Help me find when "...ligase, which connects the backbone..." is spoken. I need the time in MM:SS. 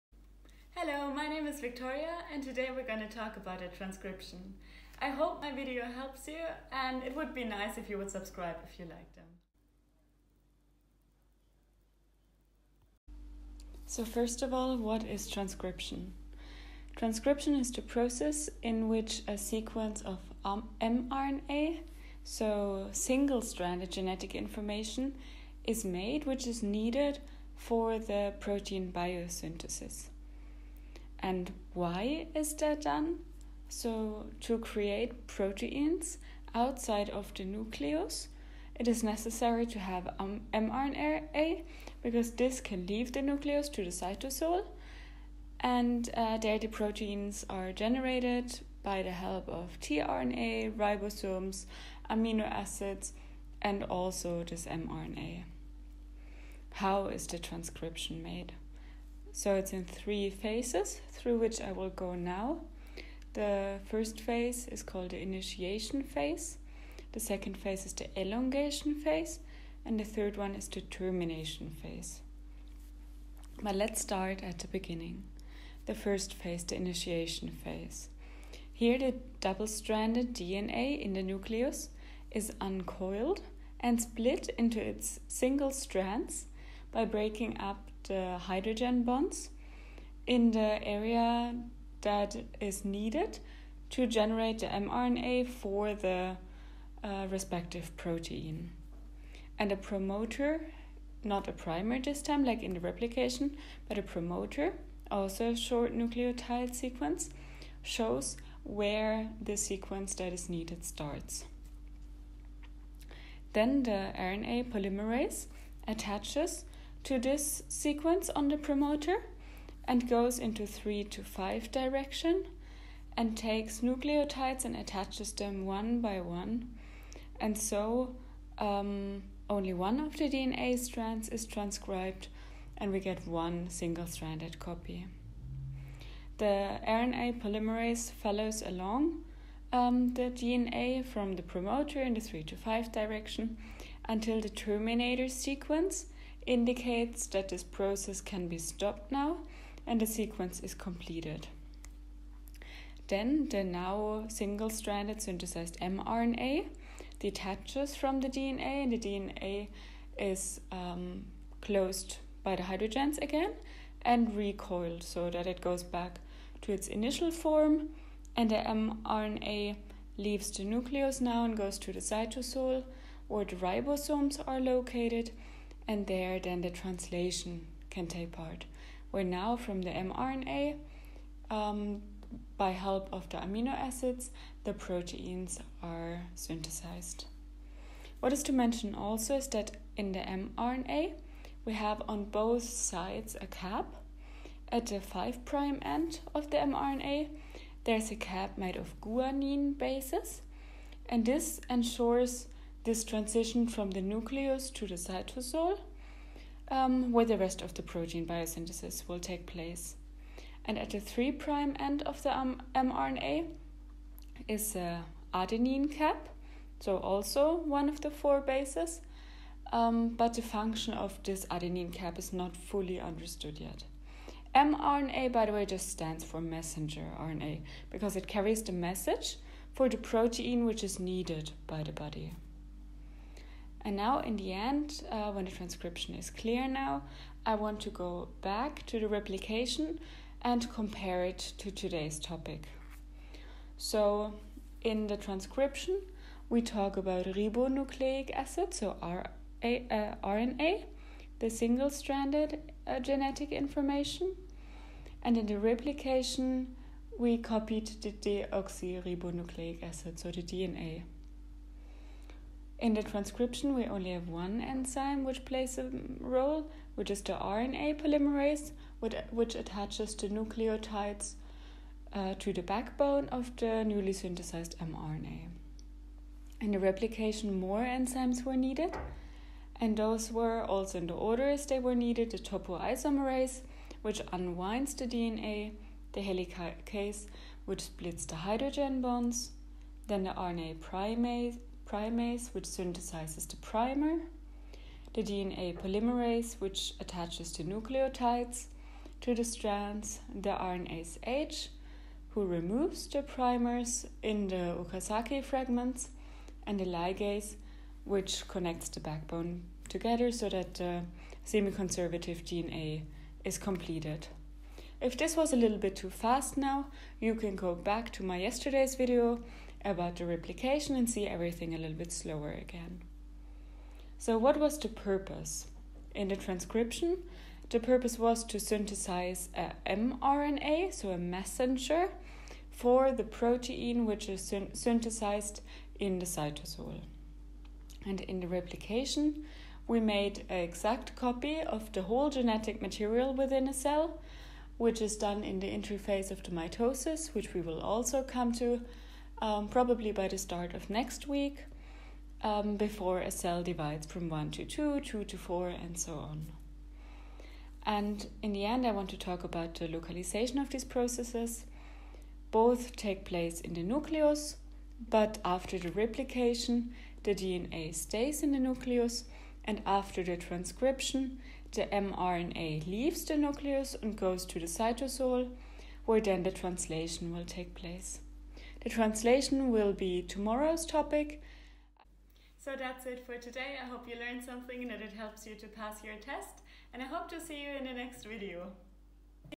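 05:06.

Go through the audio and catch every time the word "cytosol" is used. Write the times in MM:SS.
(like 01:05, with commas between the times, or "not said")
00:43, 02:51, 03:24, 05:36, 06:14.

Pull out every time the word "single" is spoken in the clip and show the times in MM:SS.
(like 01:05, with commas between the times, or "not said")
00:22, 01:25, 02:13, 02:34, 04:11.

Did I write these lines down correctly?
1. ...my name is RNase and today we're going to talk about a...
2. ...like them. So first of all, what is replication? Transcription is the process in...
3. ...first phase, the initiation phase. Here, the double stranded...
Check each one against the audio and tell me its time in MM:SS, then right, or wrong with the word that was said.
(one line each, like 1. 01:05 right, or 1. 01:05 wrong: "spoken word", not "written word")
1. 00:01 wrong: "Victoria", not "RNase"
2. 00:08 wrong: "transcription", not "replication"
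3. 01:15 right.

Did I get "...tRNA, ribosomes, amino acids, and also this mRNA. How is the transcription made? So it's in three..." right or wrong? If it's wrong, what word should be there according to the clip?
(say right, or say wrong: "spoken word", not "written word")
right.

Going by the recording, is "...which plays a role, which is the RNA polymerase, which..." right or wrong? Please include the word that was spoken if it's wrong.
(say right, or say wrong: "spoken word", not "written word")
right.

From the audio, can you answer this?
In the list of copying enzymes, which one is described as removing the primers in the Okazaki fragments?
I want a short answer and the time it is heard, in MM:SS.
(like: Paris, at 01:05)
RNase H, at 05:00.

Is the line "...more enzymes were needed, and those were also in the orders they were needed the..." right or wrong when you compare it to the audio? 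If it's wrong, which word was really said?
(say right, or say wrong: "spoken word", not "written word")
right.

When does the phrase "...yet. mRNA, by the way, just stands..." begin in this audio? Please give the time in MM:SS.
03:43.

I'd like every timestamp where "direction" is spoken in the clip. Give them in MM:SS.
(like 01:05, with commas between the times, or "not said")
02:01, 02:22.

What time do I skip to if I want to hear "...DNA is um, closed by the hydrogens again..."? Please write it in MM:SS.
02:38.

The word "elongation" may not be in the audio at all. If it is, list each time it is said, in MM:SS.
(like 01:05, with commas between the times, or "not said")
01:08.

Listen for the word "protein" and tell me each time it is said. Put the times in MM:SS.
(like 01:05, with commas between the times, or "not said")
00:28, 00:35, 00:46, 01:37, 03:04, 03:27, 03:49, 05:33.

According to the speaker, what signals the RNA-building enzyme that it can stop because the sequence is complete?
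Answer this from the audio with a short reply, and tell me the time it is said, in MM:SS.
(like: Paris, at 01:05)
terminator sequence, at 02:24.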